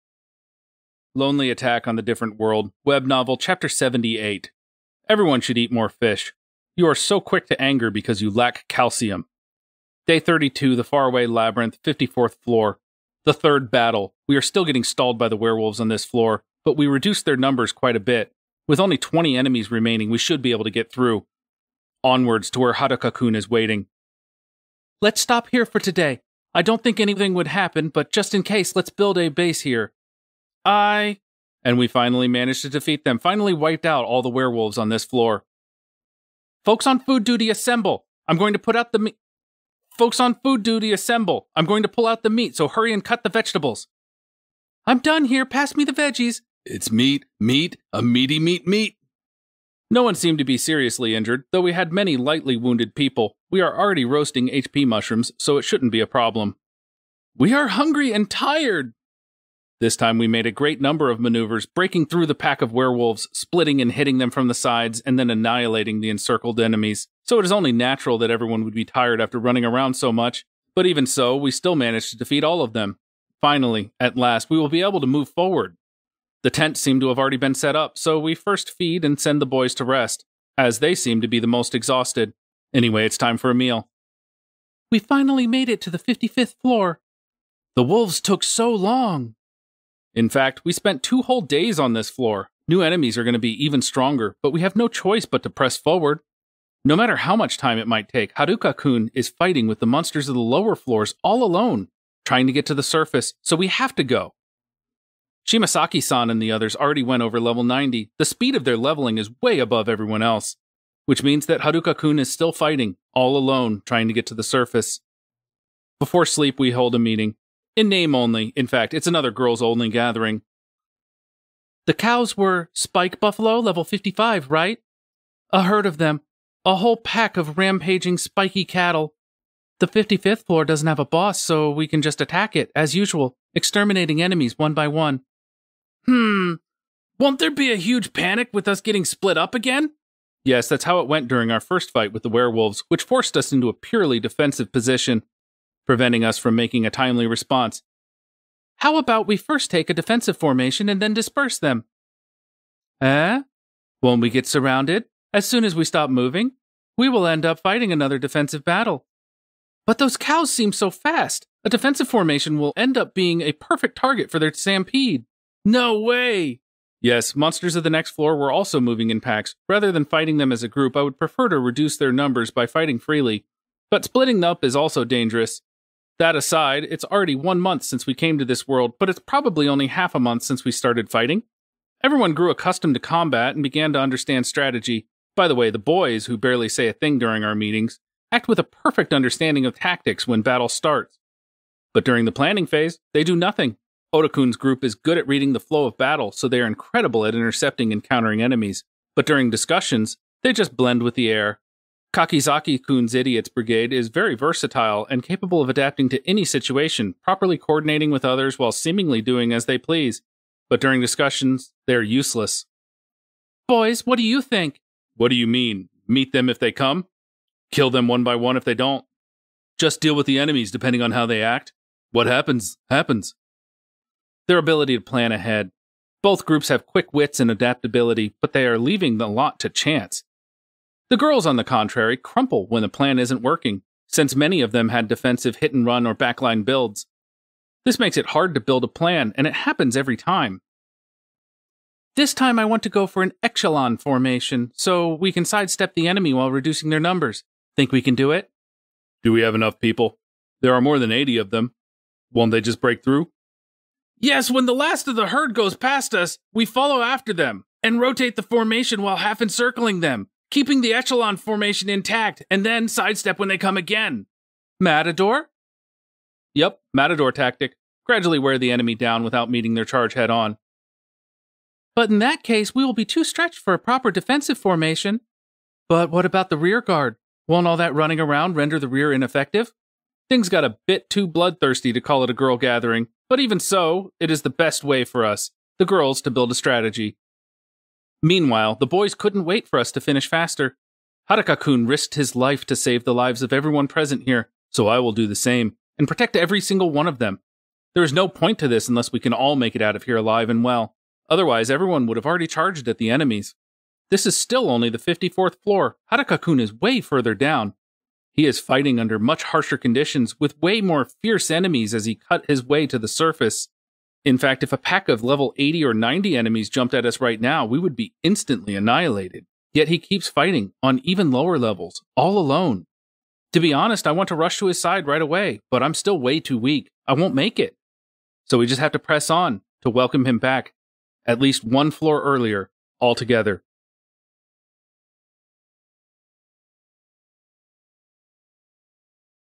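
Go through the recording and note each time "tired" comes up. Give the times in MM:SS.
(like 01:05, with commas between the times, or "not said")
00:58, 01:08.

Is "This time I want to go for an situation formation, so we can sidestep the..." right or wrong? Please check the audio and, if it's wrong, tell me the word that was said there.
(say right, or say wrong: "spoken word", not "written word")
wrong: "echelon", not "situation".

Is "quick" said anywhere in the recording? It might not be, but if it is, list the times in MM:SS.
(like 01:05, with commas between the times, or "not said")
00:07, 03:46.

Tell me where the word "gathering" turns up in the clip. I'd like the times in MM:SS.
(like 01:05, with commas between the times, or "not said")
01:59, 04:42.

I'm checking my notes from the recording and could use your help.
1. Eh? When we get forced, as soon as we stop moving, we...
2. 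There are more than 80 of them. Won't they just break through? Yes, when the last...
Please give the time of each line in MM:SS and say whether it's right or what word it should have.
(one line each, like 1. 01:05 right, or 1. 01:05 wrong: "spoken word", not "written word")
1. 02:33 wrong: "surrounded", not "forced"
2. 04:10 right.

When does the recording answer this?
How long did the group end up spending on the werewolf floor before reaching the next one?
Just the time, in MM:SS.
01:31.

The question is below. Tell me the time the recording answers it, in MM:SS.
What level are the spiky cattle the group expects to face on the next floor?
02:03.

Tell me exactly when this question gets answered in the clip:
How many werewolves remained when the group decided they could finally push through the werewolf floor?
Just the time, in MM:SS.
00:18.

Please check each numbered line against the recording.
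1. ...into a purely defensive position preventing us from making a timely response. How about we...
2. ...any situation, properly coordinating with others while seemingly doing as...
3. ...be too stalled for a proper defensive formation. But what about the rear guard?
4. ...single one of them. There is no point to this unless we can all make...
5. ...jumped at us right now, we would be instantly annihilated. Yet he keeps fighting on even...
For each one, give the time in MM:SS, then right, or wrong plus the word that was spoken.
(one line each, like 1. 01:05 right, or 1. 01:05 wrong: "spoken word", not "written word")
1. 02:23 right
2. 03:26 right
3. 04:32 wrong: "stretched", not "stalled"
4. 04:56 right
5. 05:16 right.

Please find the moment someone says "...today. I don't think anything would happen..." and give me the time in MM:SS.
00:25.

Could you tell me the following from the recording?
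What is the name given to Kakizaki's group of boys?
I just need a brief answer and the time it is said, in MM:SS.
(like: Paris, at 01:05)
Idiots Brigade, at 03:23.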